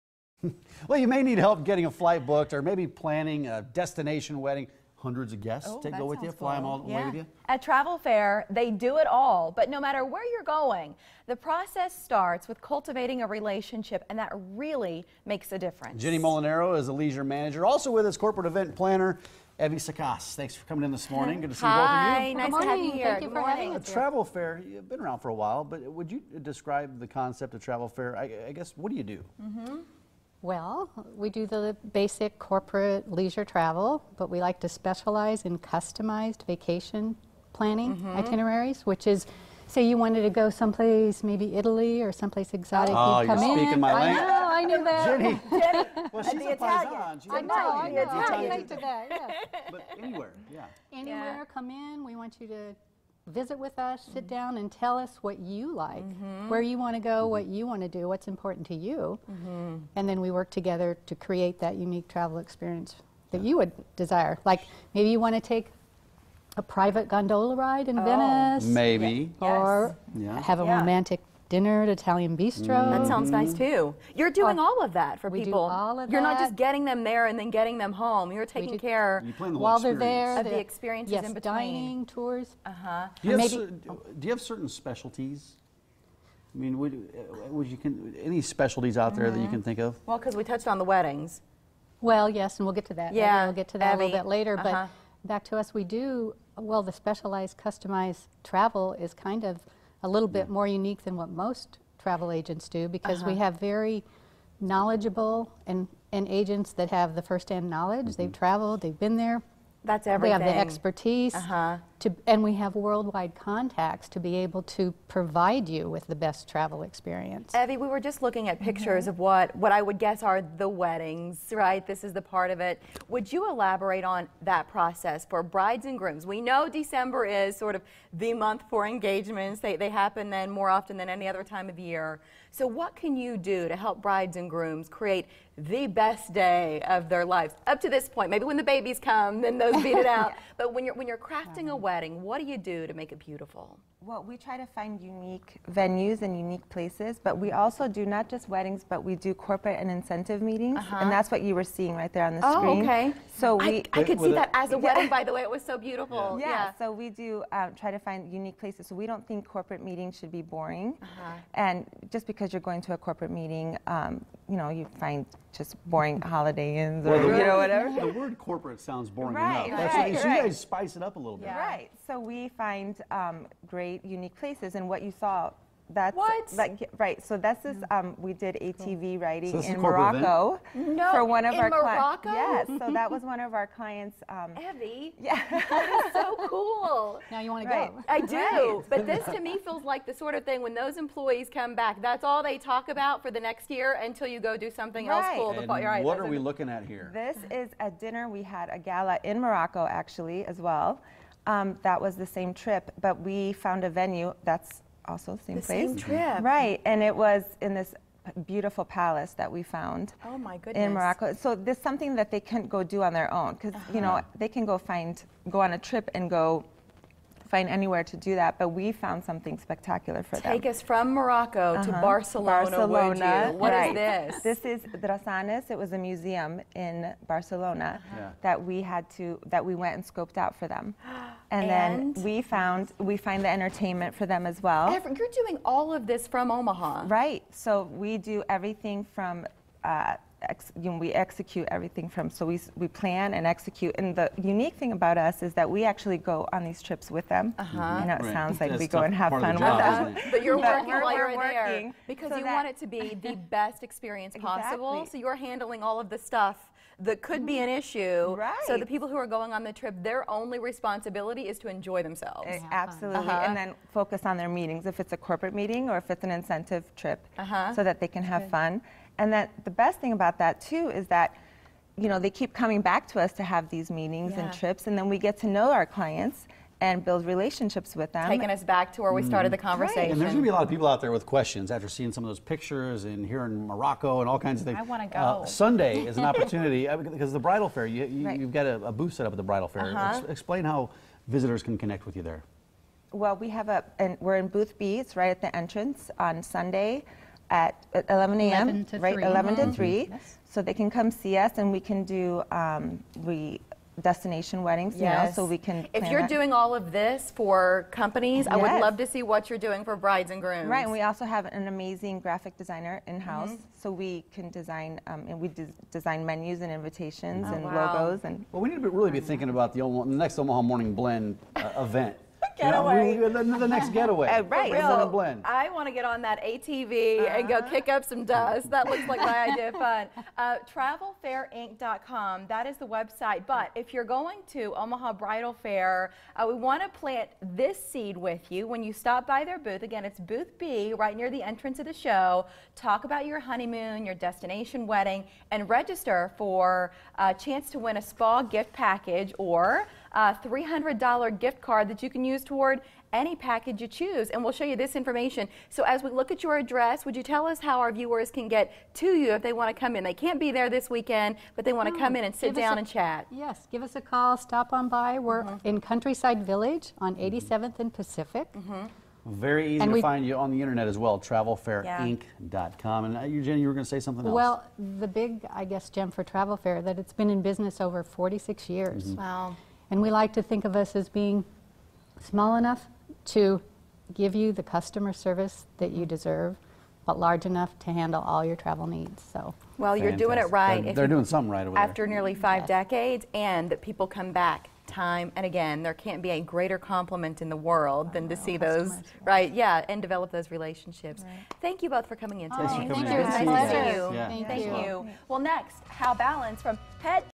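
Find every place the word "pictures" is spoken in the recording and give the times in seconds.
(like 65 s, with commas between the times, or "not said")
118 s, 282 s.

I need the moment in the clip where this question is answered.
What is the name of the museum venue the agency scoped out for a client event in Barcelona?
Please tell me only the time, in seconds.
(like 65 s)
225 s.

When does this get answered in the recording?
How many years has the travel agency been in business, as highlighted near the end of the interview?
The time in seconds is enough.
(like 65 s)
378 s.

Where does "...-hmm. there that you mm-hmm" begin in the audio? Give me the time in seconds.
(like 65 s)
89 s.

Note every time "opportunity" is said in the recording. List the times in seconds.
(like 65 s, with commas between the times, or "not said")
286 s.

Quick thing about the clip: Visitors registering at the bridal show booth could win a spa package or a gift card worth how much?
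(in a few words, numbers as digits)
$300.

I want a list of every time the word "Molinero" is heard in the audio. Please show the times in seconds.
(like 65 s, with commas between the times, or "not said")
16 s.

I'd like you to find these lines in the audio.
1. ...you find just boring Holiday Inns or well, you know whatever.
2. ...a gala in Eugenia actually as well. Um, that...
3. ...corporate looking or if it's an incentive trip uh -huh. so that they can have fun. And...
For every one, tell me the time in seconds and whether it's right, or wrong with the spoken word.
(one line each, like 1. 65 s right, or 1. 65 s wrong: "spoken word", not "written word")
1. 164 s right
2. 198 s wrong: "Morocco", not "Eugenia"
3. 265 s wrong: "meeting", not "looking".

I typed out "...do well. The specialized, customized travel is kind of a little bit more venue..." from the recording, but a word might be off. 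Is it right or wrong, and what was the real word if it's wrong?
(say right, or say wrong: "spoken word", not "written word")
wrong: "unique", not "venue".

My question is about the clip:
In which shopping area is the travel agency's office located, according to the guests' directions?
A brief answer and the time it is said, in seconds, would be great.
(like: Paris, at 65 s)
Countryside Village, at 365 s.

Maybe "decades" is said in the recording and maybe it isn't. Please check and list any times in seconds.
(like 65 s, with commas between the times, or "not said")
392 s.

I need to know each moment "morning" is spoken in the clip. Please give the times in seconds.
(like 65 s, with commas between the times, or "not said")
21 s, 320 s.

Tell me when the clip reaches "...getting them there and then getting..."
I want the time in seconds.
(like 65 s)
76 s.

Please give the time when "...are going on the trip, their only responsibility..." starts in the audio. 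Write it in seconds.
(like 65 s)
259 s.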